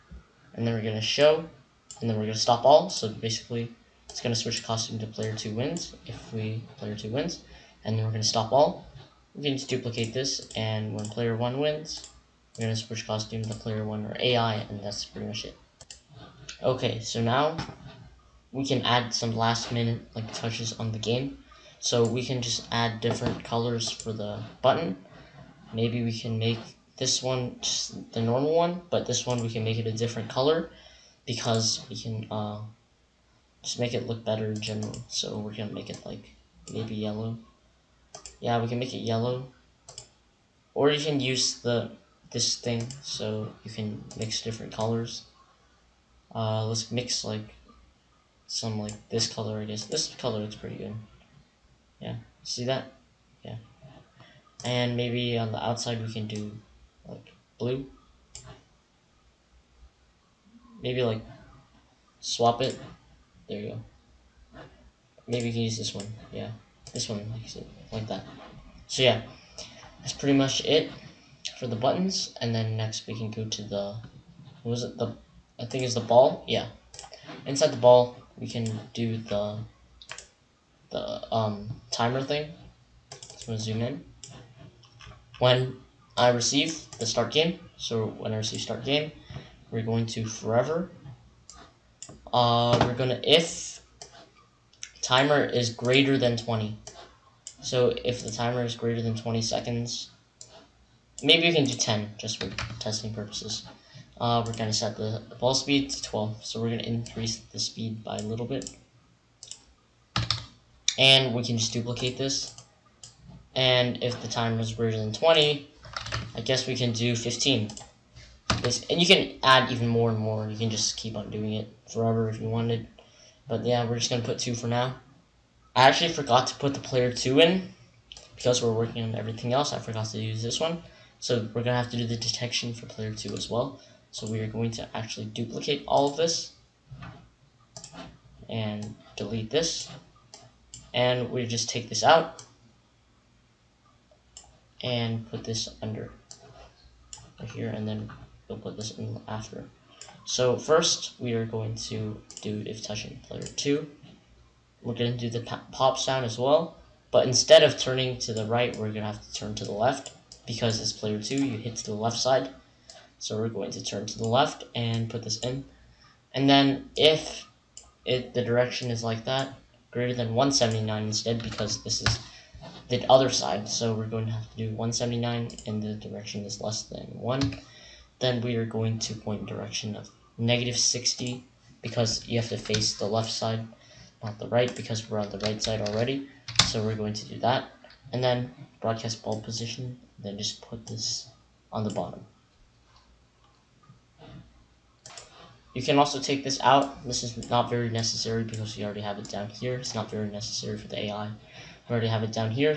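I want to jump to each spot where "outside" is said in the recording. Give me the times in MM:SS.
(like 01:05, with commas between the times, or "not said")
00:55.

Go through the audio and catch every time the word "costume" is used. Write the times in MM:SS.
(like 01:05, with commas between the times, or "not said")
00:04, 00:13.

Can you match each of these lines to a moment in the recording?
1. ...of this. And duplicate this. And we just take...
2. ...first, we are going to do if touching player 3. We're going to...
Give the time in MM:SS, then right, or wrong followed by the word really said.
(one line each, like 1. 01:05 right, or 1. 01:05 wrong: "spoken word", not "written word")
1. 02:16 wrong: "delete", not "duplicate"
2. 02:30 wrong: "2", not "3".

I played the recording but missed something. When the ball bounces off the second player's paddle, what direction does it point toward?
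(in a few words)
-60.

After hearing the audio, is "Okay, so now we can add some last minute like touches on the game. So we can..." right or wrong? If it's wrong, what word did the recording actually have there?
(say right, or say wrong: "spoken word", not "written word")
right.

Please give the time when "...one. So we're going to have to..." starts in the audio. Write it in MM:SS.
02:10.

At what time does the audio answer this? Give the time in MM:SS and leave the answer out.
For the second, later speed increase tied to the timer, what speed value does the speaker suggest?
01:57.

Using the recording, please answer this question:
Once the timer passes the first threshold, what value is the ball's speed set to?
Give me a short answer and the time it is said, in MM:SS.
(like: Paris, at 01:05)
12, at 01:46.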